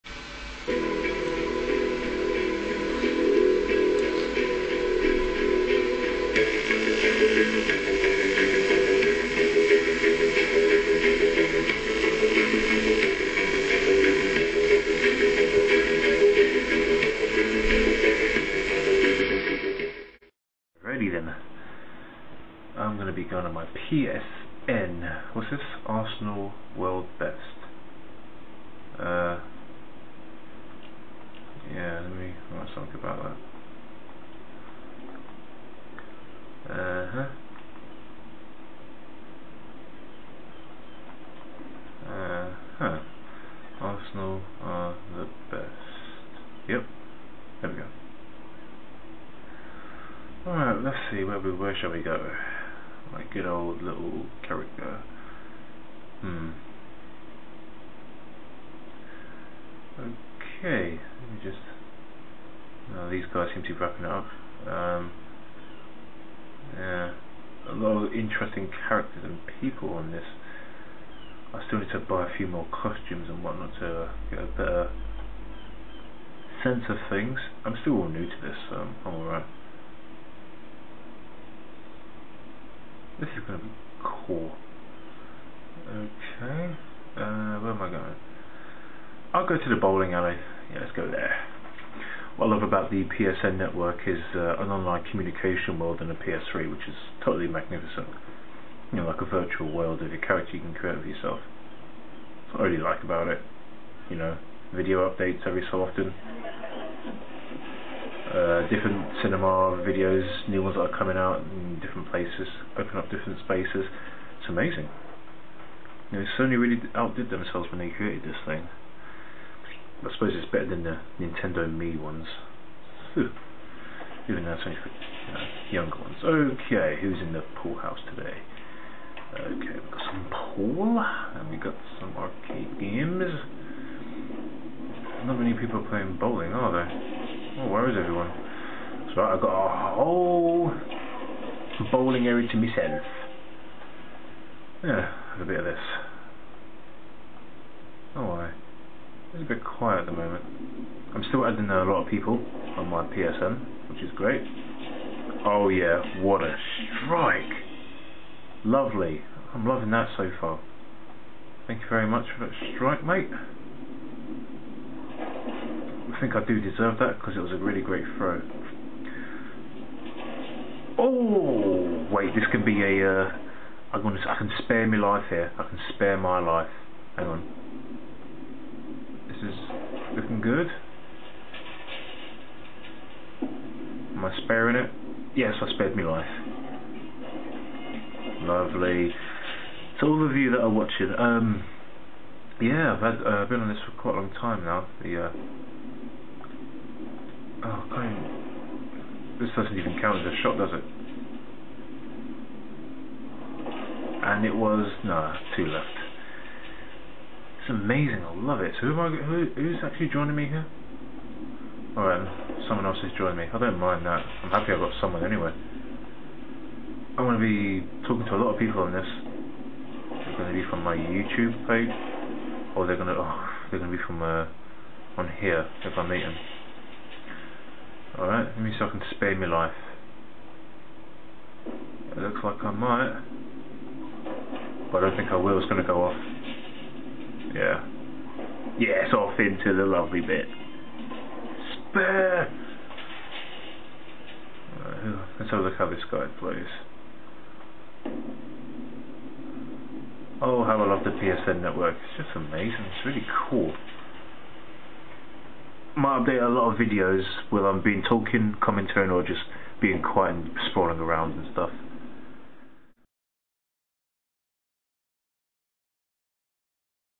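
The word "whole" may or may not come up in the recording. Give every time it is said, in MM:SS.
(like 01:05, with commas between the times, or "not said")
02:19.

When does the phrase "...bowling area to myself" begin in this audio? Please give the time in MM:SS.
02:21.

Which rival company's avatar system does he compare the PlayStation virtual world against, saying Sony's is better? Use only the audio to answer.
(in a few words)
Nintendo.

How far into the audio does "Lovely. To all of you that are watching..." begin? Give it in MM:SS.
03:08.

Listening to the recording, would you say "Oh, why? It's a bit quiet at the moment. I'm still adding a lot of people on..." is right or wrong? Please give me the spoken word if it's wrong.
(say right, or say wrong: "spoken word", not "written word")
right.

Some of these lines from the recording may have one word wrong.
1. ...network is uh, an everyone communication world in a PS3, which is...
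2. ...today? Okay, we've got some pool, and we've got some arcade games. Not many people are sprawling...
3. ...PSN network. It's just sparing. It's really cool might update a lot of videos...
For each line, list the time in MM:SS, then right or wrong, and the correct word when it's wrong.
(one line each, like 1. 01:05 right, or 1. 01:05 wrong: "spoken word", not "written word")
1. 01:33 wrong: "online", not "everyone"
2. 02:08 wrong: "playing", not "sprawling"
3. 04:11 wrong: "amazing", not "sparing".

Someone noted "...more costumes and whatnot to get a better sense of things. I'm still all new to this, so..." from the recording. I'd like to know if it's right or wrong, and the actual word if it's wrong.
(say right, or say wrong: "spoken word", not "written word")
right.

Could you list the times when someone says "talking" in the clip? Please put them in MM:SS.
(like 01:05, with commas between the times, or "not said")
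03:38, 04:18.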